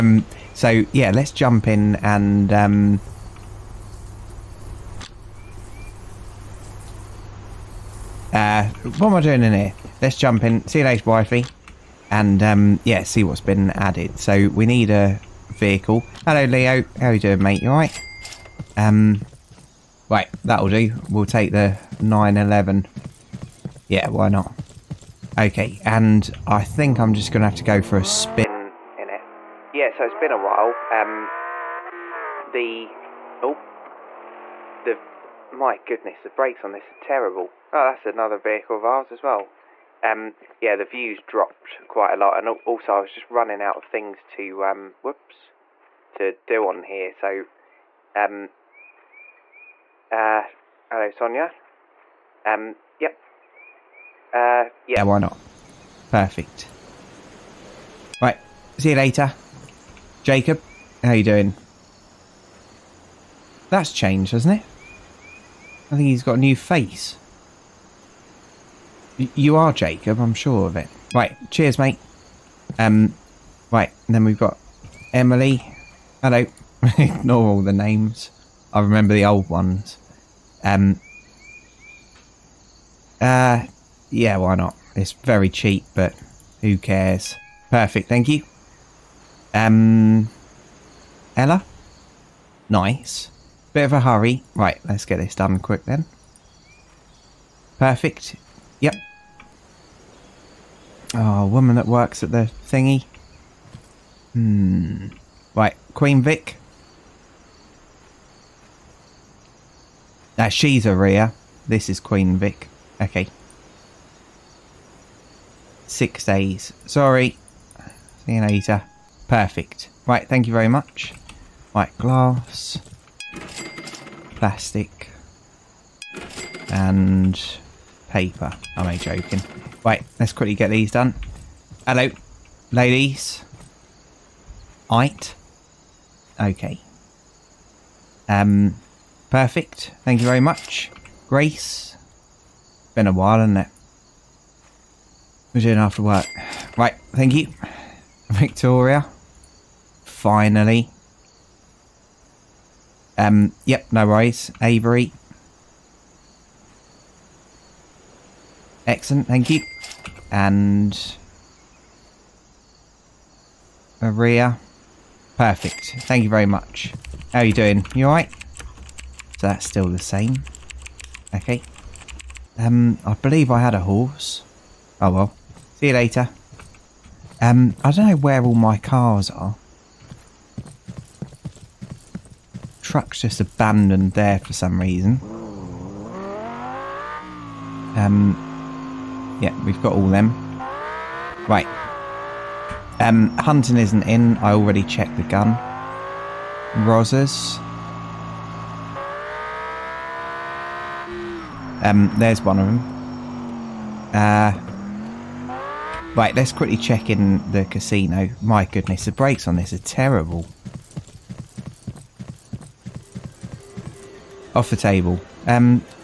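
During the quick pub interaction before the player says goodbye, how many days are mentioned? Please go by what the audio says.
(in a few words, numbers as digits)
6.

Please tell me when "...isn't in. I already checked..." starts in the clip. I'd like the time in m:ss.
3:13.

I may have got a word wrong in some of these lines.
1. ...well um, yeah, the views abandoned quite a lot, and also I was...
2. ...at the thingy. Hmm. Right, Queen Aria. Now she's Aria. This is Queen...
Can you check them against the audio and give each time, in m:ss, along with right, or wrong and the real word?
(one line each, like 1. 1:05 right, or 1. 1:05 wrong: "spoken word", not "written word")
1. 0:39 wrong: "dropped", not "abandoned"
2. 1:42 wrong: "Vic", not "Aria".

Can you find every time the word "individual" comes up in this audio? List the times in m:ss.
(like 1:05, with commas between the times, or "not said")
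not said.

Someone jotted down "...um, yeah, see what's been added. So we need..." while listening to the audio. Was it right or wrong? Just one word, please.
right.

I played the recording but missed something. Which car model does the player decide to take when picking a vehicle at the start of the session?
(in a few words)
911.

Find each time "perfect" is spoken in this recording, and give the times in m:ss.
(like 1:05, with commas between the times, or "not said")
0:56, 1:27, 1:37, 1:59, 2:19, 2:45.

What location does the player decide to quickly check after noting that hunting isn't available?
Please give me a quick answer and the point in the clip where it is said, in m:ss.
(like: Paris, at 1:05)
the casino, at 3:27.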